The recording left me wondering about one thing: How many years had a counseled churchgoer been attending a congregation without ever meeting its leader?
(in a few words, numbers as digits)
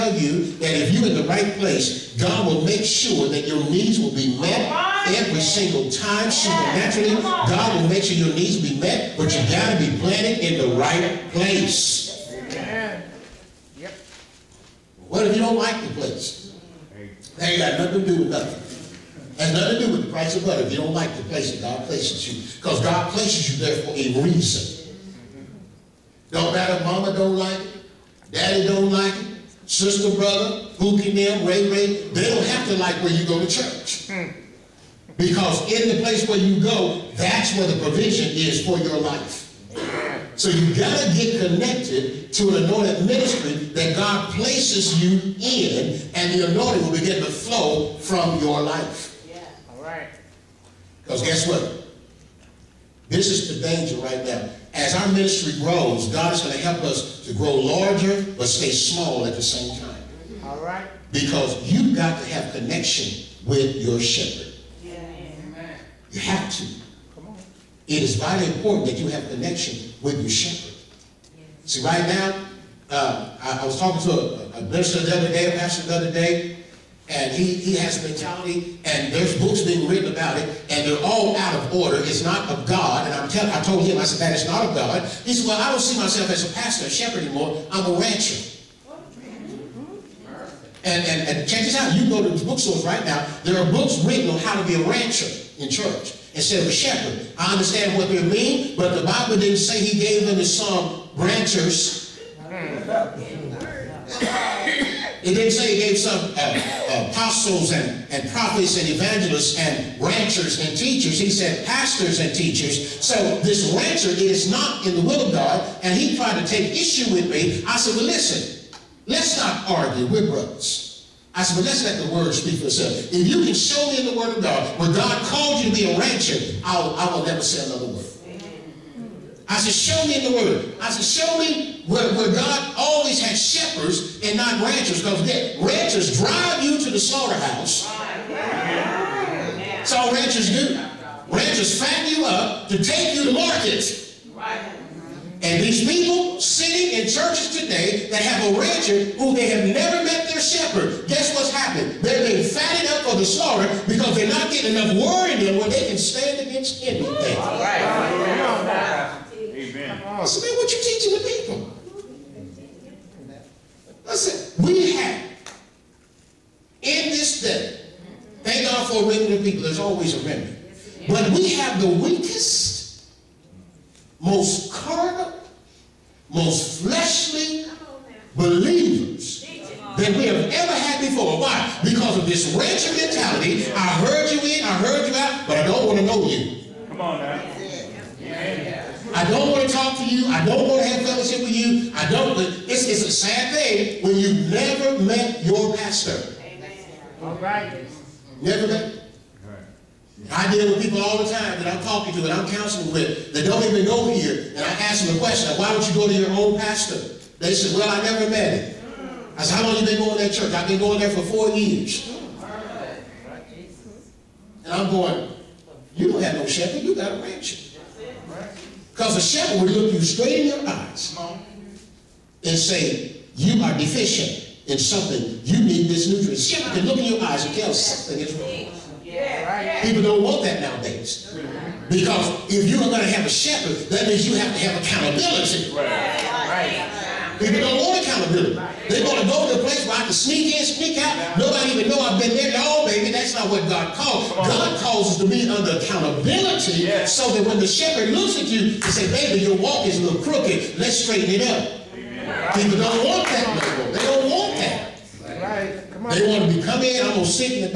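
4.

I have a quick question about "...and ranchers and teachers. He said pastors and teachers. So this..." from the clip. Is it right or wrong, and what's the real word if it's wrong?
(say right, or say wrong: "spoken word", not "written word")
right.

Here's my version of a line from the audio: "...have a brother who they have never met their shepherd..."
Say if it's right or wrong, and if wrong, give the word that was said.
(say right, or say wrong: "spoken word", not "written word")
wrong: "rancher", not "brother".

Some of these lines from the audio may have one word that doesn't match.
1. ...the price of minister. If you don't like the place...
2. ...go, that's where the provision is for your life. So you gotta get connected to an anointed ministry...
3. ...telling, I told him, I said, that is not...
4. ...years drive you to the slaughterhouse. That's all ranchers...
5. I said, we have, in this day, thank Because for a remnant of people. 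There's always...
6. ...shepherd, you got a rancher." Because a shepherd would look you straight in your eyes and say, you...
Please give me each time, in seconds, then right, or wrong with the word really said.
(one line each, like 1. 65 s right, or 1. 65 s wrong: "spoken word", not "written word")
1. 20 s wrong: "butter", not "minister"
2. 36 s right
3. 83 s right
4. 135 s wrong: "ranchers", not "years"
5. 164 s wrong: "God", not "Because"
6. 216 s right.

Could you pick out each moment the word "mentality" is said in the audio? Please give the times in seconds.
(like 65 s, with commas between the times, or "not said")
78 s, 182 s.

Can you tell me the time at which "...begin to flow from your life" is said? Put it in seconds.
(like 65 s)
46 s.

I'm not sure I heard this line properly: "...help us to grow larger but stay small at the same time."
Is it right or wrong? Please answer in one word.
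right.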